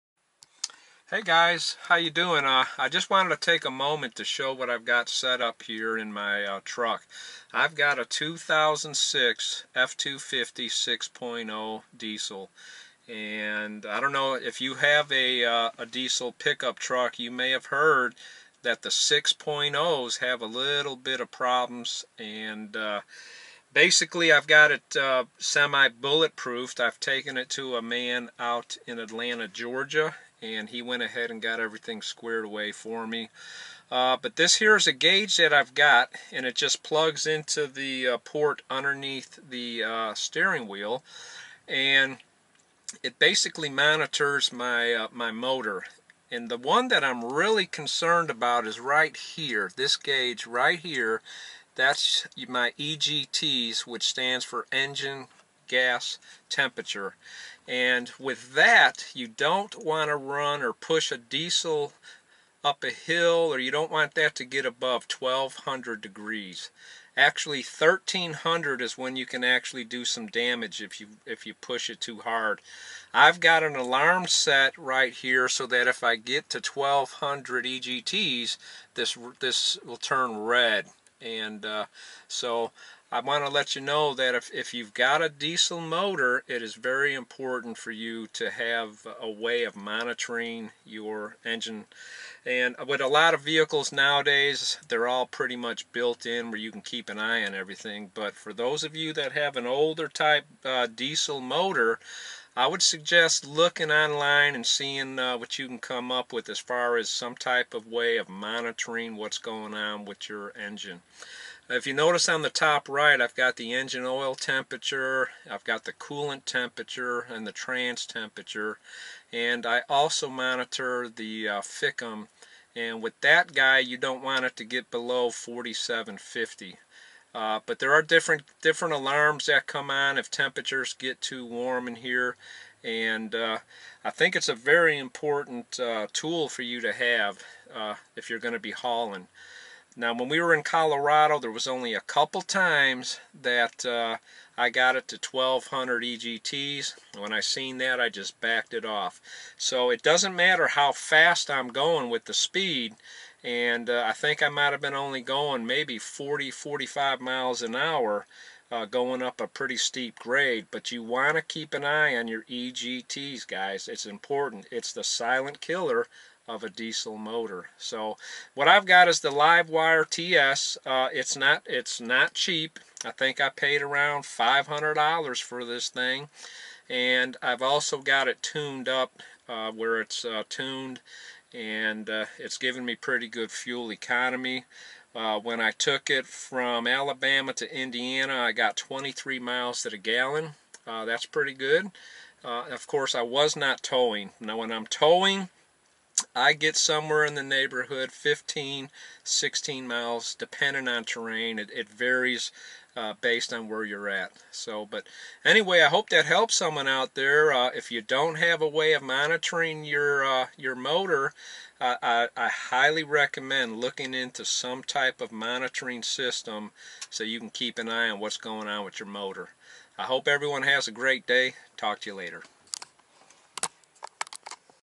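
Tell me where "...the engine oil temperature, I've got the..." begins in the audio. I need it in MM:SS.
01:53.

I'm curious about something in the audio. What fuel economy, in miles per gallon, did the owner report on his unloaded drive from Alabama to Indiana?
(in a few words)
23.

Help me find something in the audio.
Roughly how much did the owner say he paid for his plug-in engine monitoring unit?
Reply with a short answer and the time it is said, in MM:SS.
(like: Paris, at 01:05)
$500, at 02:54.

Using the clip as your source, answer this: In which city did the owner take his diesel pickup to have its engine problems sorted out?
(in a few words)
Atlanta, Georgia.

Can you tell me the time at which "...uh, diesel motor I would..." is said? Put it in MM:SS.
01:40.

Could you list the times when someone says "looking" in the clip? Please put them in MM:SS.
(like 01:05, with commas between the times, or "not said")
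01:43, 03:33.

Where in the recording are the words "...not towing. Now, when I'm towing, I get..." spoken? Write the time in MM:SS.
03:13.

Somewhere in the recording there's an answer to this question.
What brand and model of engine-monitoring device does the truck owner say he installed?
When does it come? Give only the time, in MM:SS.
02:49.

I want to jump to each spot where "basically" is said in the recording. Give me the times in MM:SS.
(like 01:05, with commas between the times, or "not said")
00:23, 00:43.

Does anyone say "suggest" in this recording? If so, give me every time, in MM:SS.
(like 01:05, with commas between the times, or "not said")
01:42.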